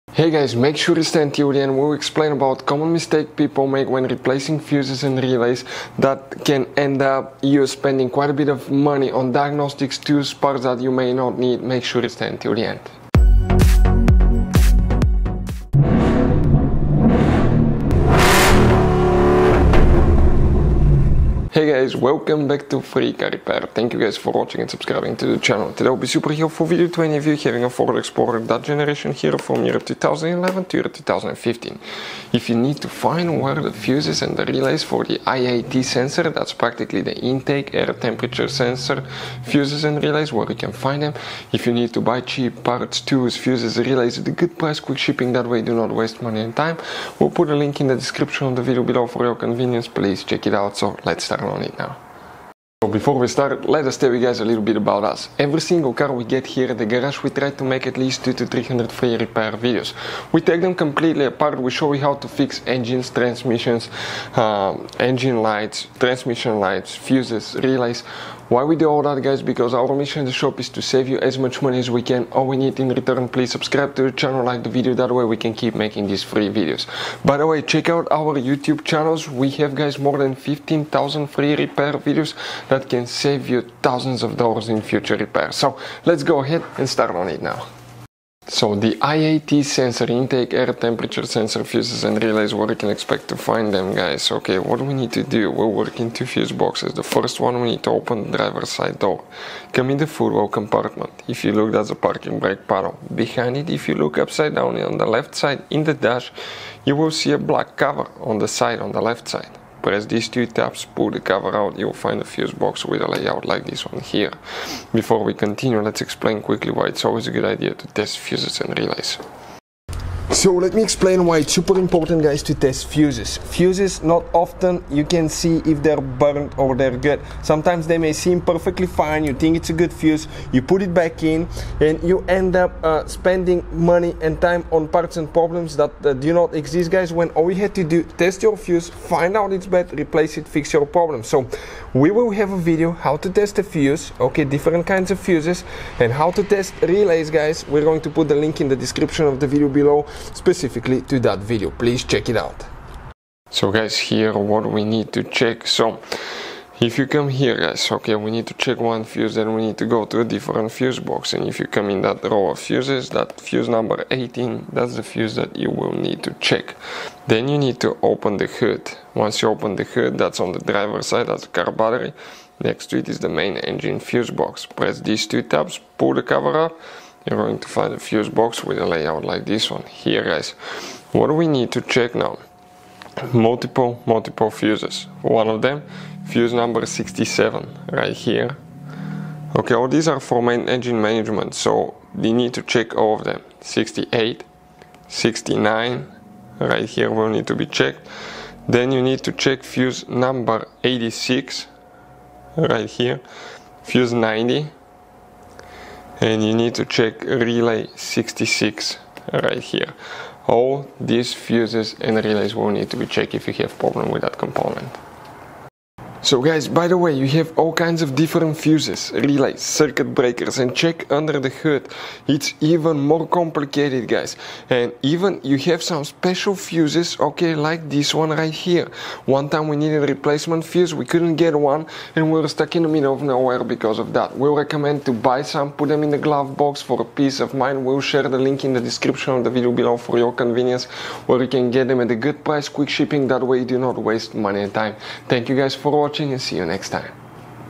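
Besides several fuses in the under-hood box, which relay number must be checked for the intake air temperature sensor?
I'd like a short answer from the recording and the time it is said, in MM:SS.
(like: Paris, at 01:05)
66, at 03:27.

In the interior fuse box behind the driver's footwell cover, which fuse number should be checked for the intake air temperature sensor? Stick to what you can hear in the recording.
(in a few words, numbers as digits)
18.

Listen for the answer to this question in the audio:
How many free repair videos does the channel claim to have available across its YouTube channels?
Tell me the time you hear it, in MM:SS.
01:19.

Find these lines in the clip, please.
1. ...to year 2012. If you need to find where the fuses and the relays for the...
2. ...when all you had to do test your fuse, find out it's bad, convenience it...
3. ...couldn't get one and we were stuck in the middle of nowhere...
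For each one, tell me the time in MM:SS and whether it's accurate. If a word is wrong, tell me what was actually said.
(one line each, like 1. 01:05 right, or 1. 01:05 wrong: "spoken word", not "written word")
1. 00:30 wrong: "2015", not "2012"
2. 02:17 wrong: "replace", not "convenience"
3. 03:51 right.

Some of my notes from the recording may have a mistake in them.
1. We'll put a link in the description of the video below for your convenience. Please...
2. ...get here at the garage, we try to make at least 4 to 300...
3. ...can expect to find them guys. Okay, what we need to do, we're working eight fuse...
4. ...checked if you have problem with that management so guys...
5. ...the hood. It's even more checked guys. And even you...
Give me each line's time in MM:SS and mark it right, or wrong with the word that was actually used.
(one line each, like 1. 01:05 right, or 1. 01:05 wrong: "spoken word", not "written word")
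1. 00:47 right
2. 00:56 wrong: "2", not "4"
3. 01:32 wrong: "two", not "eight"
4. 03:33 wrong: "component", not "management"
5. 03:41 wrong: "complicated", not "checked".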